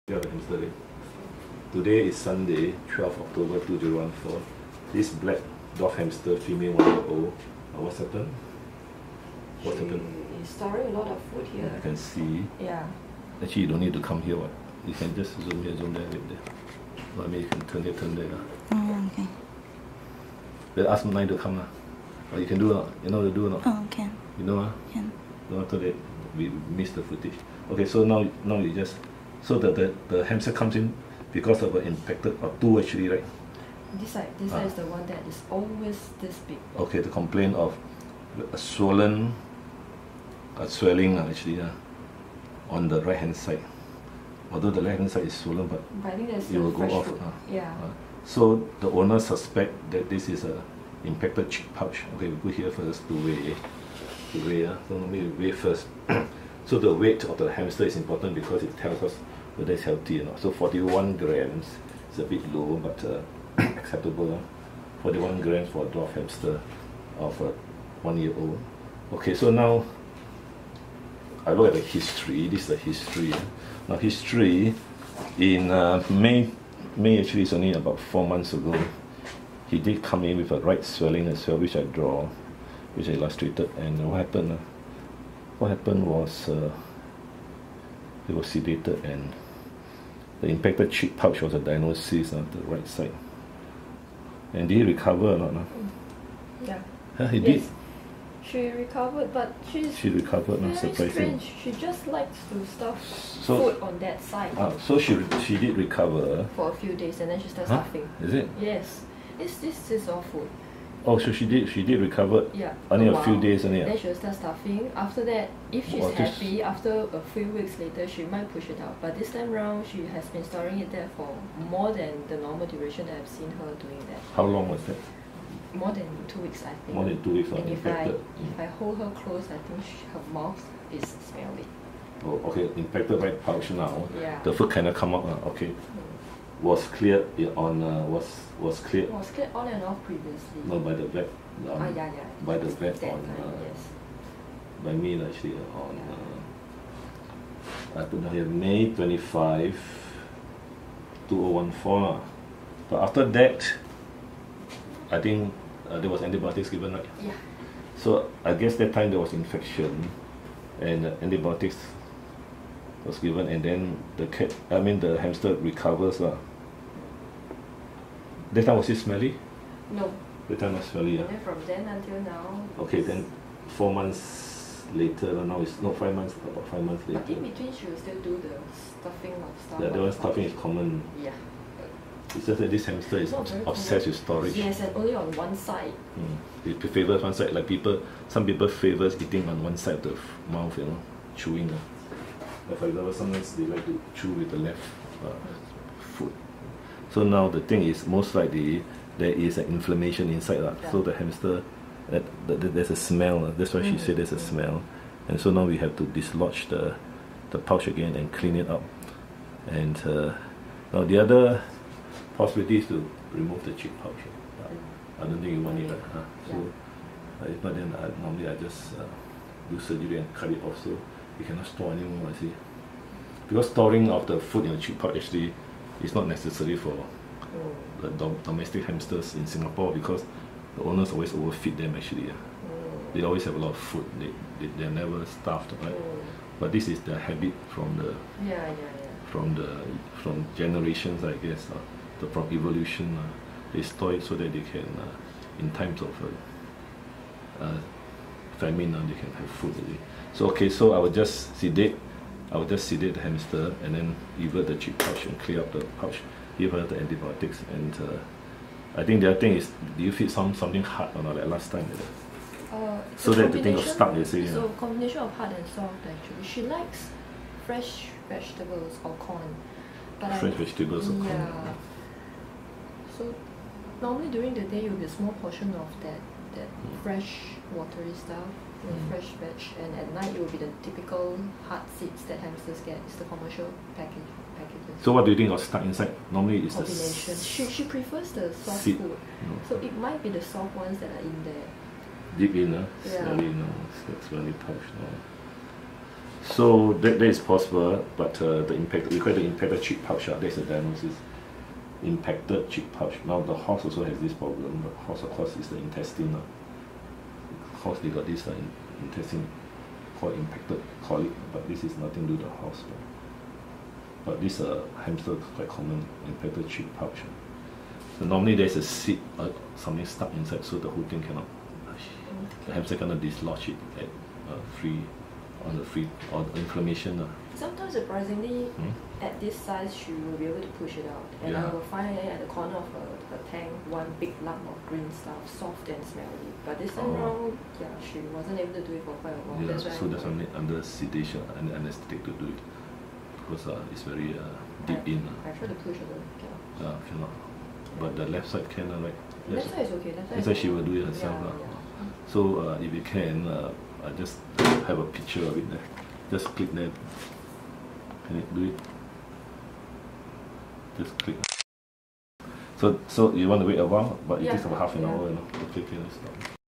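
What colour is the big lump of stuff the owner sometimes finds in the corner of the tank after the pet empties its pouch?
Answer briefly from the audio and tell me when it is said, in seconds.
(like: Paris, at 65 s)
green, at 334 s.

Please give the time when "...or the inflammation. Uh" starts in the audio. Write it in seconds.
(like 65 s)
326 s.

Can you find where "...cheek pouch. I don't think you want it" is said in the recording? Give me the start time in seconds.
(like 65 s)
213 s.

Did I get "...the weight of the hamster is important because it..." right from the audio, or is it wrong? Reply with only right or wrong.
right.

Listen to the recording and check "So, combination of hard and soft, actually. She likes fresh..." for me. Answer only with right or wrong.
right.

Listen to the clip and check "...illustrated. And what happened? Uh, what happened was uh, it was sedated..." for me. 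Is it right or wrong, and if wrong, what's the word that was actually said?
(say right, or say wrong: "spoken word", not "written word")
right.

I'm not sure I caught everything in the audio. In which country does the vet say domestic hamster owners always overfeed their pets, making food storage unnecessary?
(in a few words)
Singapore.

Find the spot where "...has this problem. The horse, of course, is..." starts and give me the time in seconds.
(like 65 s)
304 s.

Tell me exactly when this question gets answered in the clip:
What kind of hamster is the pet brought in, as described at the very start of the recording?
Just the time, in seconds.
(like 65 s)
5 s.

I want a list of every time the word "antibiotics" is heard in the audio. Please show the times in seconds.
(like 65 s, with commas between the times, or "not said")
156 s, 161 s, 256 s.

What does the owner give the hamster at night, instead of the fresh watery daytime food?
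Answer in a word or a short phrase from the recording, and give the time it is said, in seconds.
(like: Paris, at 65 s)
typical hard seeds, at 280 s.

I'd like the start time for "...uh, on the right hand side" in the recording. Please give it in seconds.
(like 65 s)
41 s.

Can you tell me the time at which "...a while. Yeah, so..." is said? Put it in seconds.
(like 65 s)
339 s.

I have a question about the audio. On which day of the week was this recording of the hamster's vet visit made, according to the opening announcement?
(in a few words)
Sunday.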